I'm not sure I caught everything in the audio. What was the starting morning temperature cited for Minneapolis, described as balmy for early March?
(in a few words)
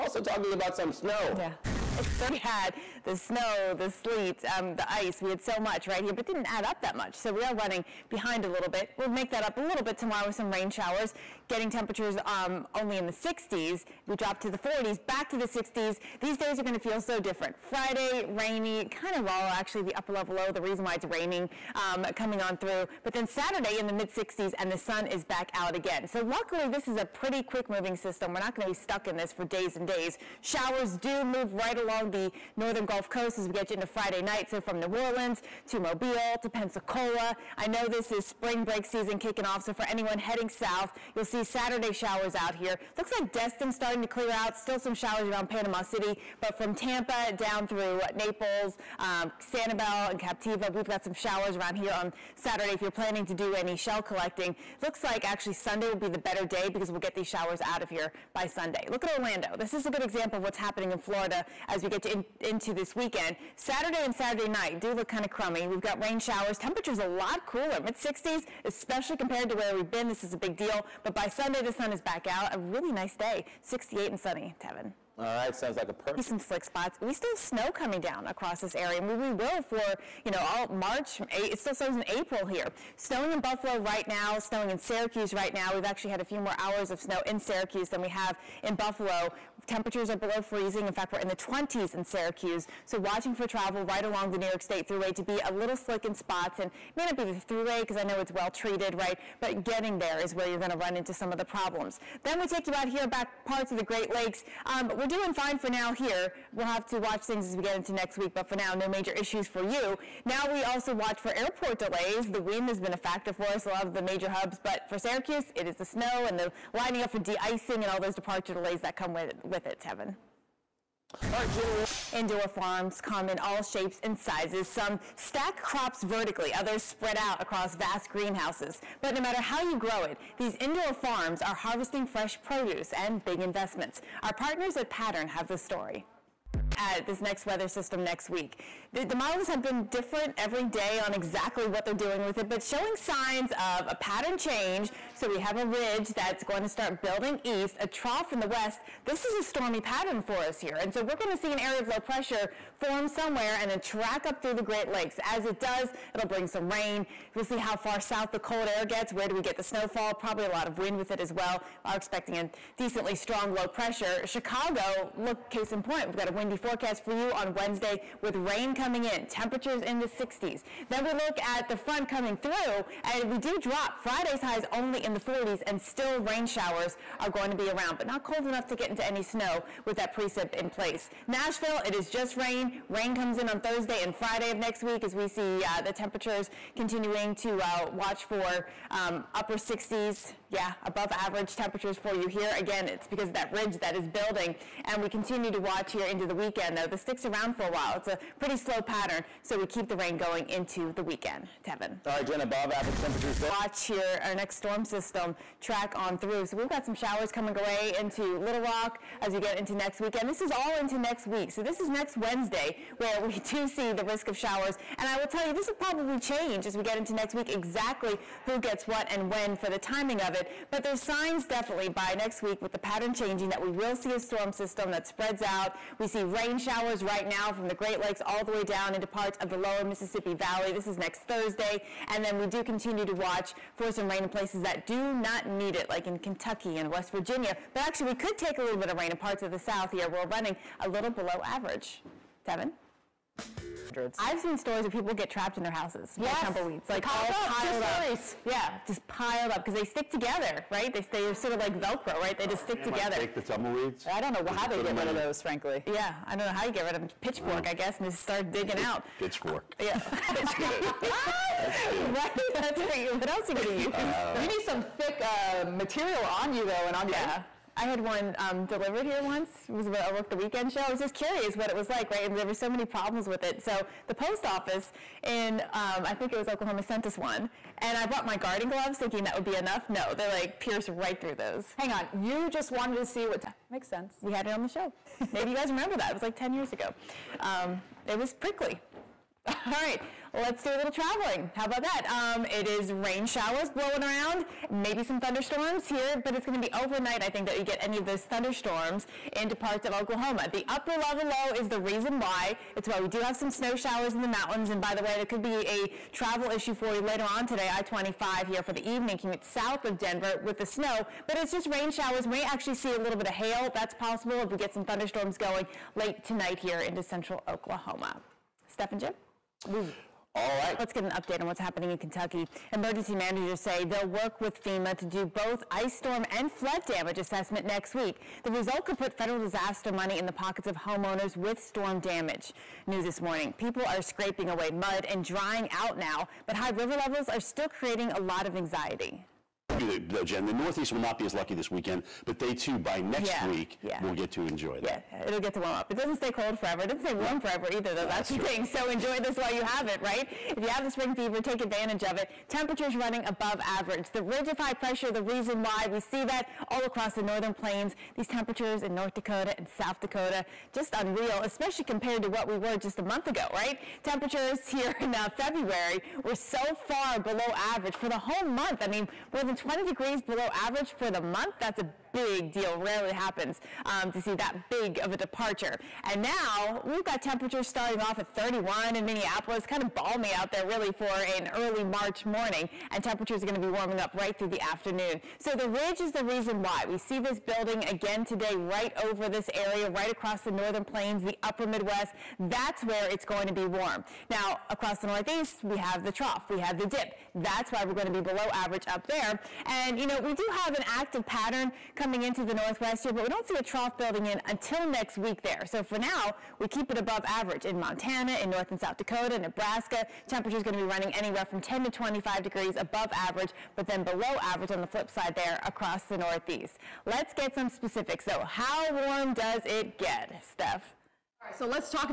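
31.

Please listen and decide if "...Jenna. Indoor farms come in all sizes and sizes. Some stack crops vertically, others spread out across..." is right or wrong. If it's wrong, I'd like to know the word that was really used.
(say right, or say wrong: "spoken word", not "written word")
wrong: "shapes", not "sizes".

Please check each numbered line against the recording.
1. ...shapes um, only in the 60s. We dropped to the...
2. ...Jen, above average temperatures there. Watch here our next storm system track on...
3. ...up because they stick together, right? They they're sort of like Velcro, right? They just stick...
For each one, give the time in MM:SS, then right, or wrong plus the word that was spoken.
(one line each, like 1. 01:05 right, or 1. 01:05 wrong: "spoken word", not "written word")
1. 00:11 wrong: "temperatures", not "shapes"
2. 03:22 right
3. 04:09 right.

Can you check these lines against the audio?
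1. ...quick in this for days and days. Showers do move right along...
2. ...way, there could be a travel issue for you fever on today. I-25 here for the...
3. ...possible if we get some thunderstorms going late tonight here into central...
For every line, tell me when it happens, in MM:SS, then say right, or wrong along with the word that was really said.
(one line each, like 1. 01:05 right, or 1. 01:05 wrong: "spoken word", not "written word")
1. 00:28 wrong: "stuck", not "quick"
2. 05:05 wrong: "later", not "fever"
3. 05:13 right.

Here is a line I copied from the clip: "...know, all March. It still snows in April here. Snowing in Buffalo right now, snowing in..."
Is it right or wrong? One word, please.
right.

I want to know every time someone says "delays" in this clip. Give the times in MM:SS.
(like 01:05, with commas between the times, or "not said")
01:51, 01:58.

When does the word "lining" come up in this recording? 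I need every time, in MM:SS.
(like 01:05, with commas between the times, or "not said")
01:56.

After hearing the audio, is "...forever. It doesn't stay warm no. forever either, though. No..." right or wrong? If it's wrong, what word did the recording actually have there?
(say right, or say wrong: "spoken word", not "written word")
right.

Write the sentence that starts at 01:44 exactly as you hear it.
Um, we're we're doing fine for now here.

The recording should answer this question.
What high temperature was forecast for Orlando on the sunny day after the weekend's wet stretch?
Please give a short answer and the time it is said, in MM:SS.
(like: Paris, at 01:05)
68, at 01:13.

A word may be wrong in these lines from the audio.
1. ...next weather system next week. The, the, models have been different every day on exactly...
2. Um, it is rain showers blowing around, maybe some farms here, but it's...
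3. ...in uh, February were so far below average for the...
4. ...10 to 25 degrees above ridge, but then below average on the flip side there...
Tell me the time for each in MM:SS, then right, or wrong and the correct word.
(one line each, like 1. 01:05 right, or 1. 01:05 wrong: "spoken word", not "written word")
1. 02:17 right
2. 04:52 wrong: "thunderstorms", not "farms"
3. 06:05 right
4. 06:51 wrong: "average", not "ridge".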